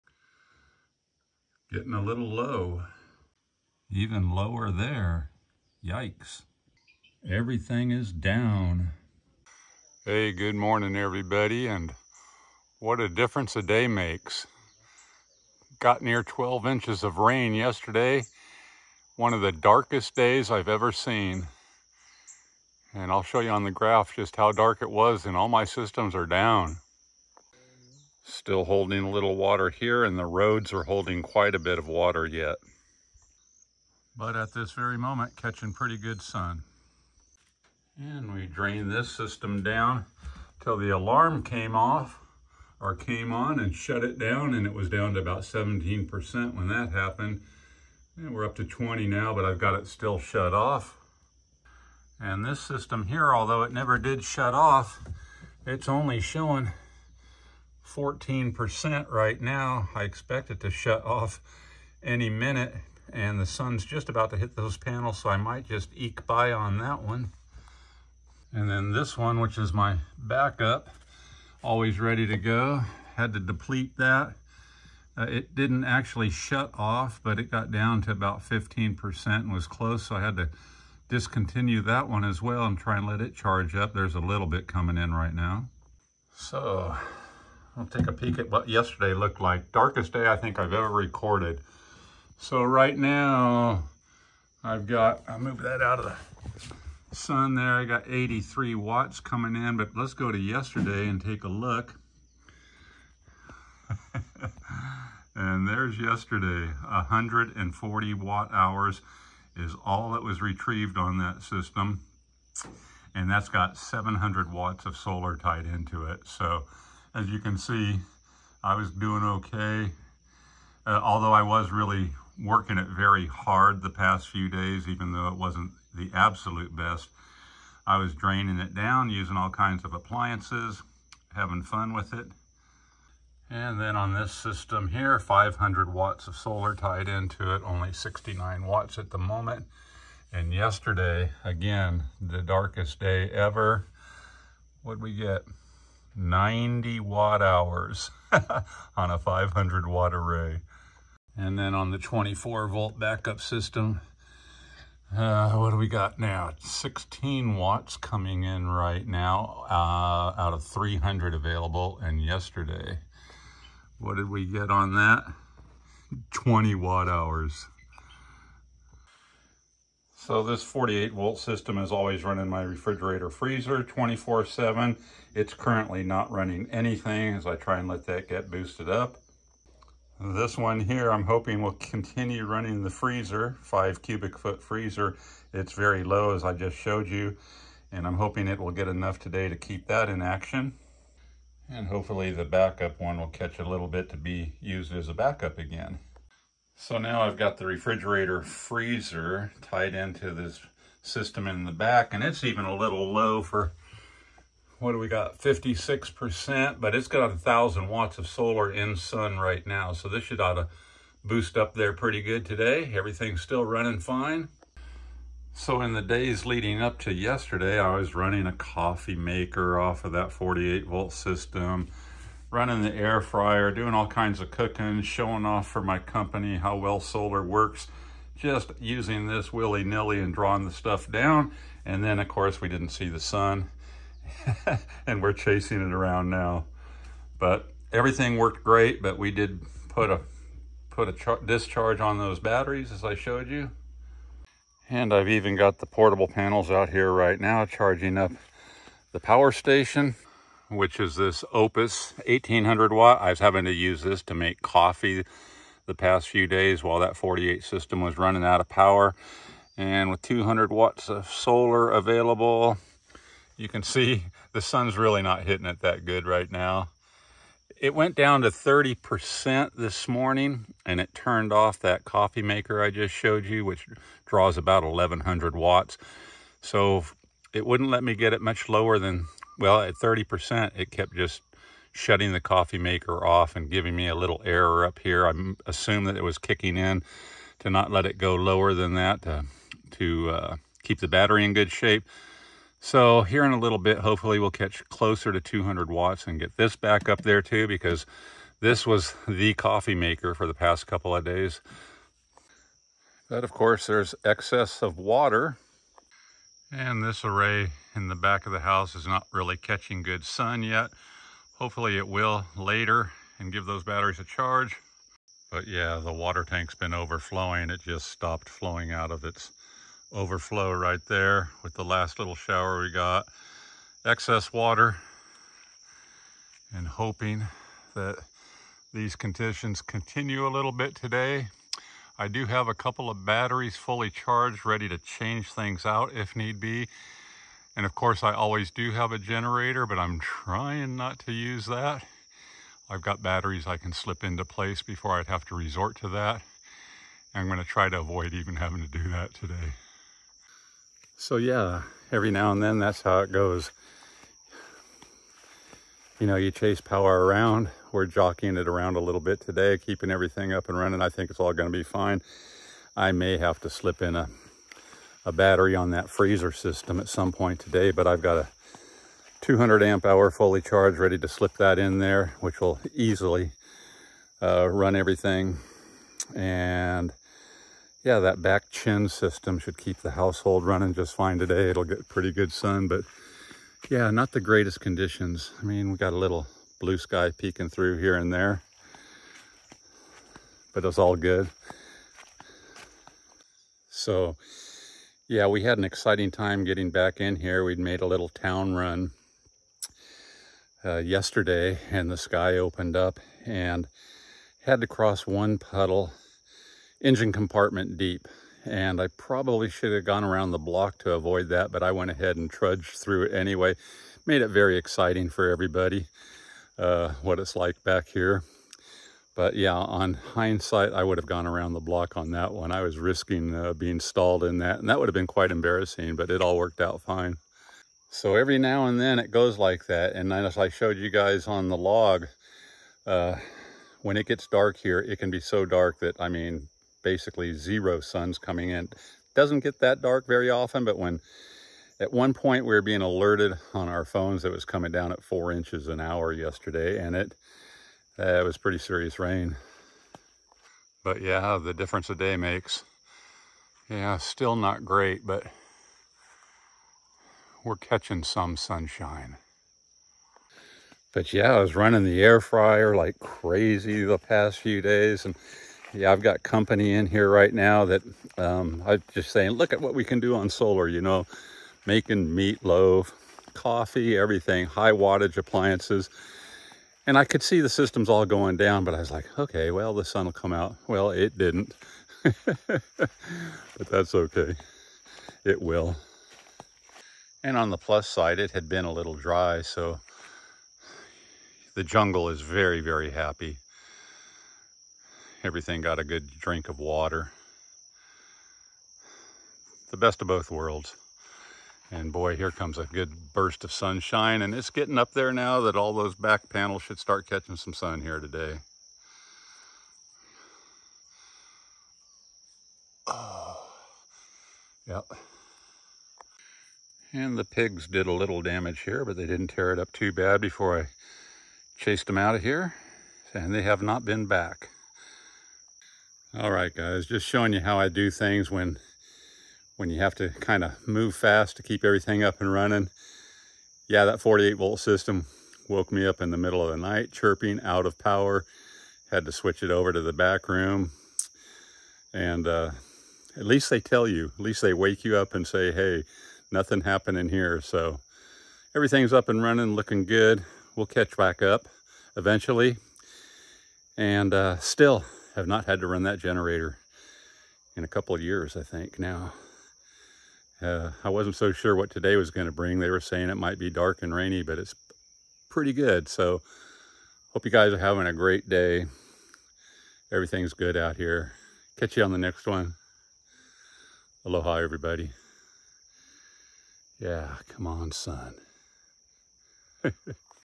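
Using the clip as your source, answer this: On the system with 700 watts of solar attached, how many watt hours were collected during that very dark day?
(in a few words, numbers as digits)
140 watt hours.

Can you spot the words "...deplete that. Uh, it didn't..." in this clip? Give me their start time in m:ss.
1:13.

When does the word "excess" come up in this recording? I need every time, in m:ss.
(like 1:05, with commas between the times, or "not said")
5:04, 5:24.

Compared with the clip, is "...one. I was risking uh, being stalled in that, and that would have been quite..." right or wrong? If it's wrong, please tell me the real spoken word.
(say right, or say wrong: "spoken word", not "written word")
right.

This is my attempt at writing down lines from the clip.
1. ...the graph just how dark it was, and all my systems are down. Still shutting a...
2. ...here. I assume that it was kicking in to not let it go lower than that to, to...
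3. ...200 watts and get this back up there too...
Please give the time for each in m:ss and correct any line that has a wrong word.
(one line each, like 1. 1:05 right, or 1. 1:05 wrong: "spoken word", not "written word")
1. 0:23 wrong: "holding", not "shutting"
2. 4:44 right
3. 4:55 right.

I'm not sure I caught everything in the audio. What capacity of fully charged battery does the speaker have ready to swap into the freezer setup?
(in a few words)
200 amp hour.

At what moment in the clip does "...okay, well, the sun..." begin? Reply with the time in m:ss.
7:59.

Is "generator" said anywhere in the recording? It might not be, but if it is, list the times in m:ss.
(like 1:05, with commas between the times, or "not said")
5:39, 9:16.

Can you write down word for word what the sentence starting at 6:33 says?
So yeah, we had an exciting time getting back in here.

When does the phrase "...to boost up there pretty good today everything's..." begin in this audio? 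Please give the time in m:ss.
3:30.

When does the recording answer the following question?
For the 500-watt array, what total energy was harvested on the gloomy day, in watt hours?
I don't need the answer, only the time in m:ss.
2:26.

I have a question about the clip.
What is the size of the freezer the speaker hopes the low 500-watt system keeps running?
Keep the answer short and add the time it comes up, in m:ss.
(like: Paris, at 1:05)
5 cubic foot, at 3:03.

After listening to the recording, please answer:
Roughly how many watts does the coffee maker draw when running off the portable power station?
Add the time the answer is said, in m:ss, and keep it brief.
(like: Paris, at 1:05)
1100 watts, at 4:34.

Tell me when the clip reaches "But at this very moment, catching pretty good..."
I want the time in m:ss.
0:34.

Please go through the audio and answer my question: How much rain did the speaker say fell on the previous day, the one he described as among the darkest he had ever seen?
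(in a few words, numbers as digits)
12 inches.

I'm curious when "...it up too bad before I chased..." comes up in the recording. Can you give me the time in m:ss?
8:39.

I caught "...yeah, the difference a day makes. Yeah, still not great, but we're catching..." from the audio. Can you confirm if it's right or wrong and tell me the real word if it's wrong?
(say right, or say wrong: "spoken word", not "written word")
right.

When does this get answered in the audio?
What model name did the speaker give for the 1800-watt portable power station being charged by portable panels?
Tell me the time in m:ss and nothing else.
4:11.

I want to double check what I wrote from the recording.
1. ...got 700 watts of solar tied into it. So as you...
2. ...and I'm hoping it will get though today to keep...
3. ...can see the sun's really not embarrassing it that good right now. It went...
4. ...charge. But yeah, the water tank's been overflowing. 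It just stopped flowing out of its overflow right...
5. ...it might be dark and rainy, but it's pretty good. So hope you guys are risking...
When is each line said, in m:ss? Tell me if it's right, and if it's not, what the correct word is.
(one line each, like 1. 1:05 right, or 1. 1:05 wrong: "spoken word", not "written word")
1. 1:53 right
2. 3:07 wrong: "enough", not "though"
3. 4:23 wrong: "hitting", not "embarrassing"
4. 5:14 right
5. 9:23 wrong: "having", not "risking".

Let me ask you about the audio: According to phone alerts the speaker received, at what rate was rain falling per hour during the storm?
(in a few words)
4 inches an hour.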